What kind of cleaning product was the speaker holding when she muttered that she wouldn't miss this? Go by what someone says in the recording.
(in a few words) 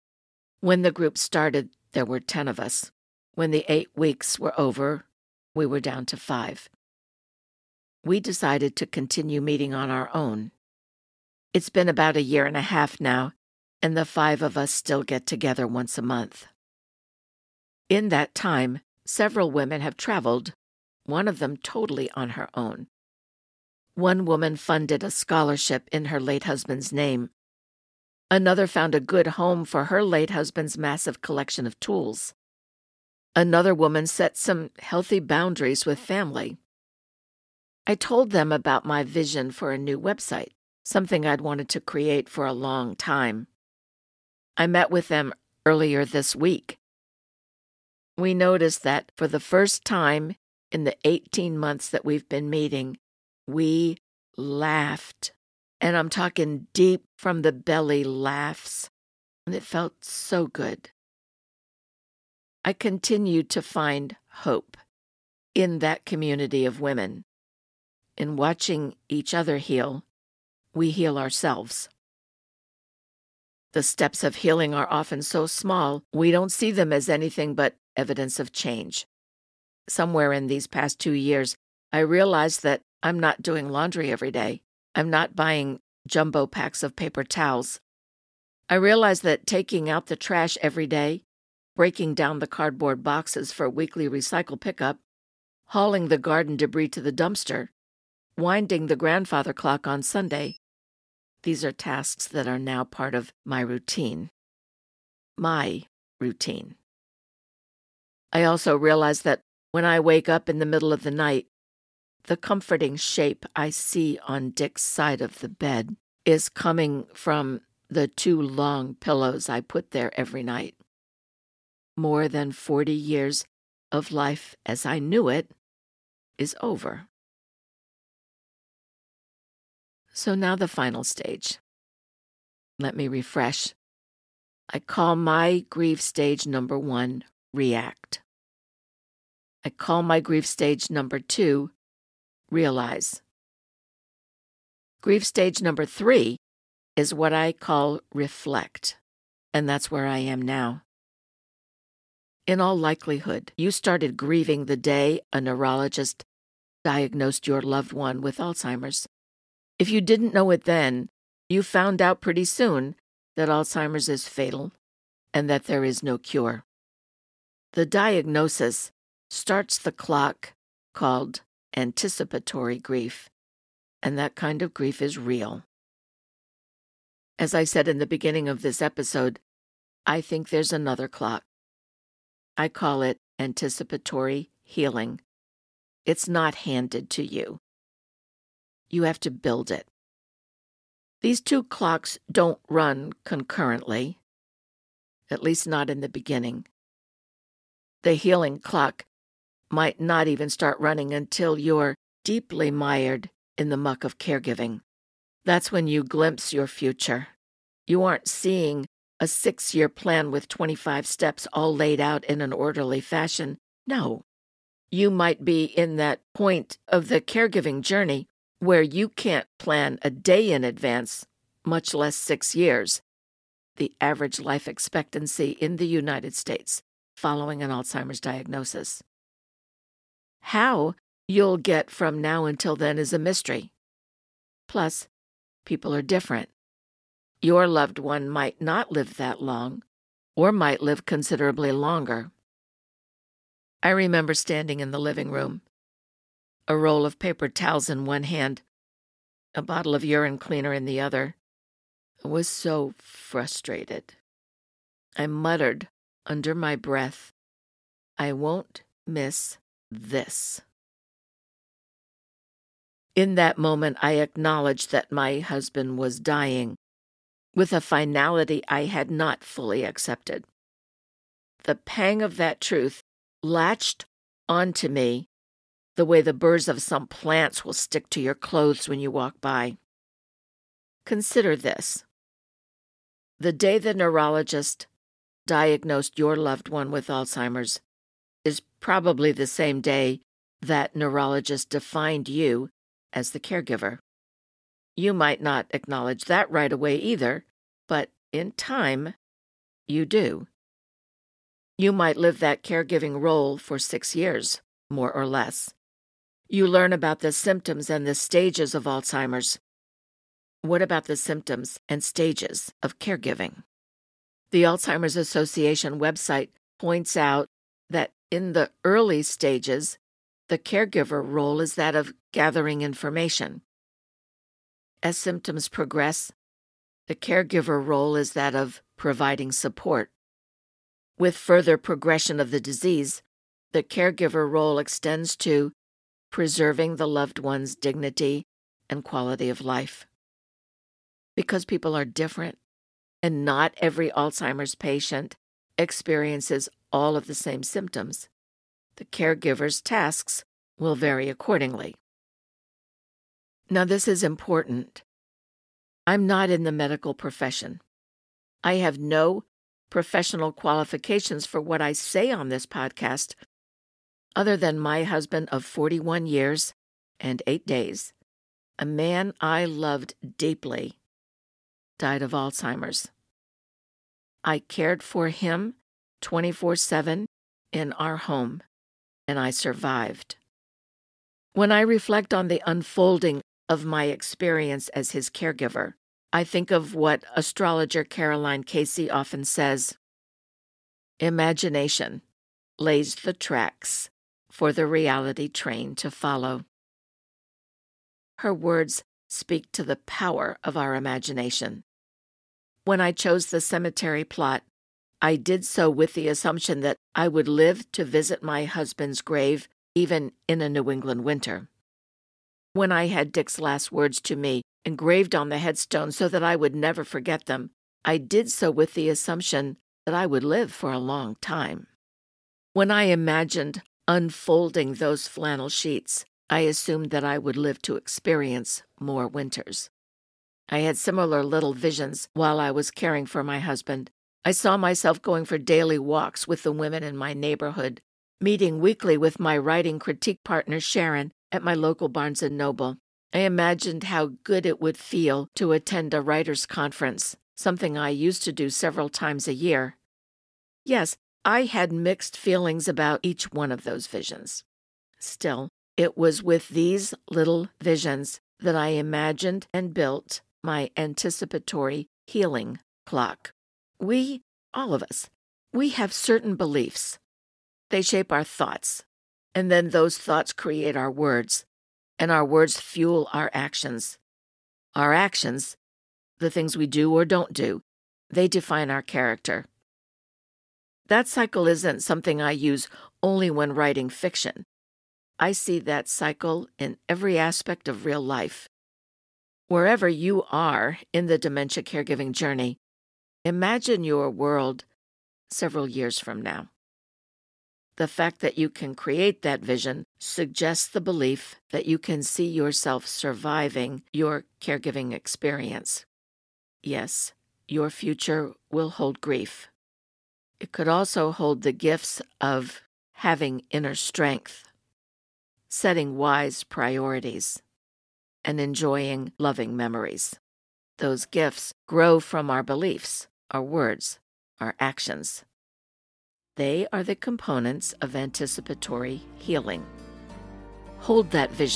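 Urine cleaner.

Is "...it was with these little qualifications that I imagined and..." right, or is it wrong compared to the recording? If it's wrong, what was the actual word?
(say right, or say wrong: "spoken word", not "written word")
wrong: "visions", not "qualifications".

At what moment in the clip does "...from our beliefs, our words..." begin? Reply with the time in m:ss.
8:42.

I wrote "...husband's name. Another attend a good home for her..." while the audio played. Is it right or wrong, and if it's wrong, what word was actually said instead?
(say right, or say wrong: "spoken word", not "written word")
wrong: "found", not "attend".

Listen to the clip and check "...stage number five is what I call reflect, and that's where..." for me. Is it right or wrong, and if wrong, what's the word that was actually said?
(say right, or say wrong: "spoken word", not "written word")
wrong: "three", not "five".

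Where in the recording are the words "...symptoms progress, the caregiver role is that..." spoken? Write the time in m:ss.
5:25.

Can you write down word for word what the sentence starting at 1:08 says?
In watching each other heal, we heal ourselves.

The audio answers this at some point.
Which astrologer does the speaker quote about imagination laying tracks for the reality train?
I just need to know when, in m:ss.
6:28.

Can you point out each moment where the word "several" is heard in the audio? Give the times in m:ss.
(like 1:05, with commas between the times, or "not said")
0:19, 7:28, 8:15.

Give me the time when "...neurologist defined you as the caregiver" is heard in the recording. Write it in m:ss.
4:50.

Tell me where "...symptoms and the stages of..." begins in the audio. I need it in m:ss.
5:07.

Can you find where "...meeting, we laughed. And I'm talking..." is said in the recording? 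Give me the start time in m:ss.
0:52.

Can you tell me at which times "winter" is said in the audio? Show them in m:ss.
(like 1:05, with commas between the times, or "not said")
6:51, 7:09.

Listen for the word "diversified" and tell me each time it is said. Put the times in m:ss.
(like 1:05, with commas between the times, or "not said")
not said.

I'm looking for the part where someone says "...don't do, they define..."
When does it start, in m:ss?
7:57.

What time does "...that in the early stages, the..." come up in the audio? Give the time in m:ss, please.
5:17.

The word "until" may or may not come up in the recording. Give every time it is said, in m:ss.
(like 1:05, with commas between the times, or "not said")
3:21, 3:52.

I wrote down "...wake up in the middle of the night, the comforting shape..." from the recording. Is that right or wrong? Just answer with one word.
right.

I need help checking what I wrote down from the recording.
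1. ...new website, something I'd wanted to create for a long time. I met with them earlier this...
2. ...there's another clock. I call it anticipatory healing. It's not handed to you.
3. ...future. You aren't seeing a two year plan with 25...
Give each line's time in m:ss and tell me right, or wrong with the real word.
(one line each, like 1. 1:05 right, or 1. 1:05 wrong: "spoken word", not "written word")
1. 0:39 right
2. 3:00 right
3. 3:26 wrong: "six", not "two".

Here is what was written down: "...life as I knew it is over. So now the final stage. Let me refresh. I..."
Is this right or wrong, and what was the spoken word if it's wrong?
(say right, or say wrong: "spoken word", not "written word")
right.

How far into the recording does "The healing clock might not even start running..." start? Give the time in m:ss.
3:18.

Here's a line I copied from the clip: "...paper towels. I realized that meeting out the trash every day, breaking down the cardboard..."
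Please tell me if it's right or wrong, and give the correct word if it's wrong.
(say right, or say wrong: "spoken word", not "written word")
wrong: "taking", not "meeting".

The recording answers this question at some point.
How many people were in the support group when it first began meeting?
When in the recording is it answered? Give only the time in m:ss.
0:02.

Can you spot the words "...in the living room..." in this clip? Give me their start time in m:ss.
4:04.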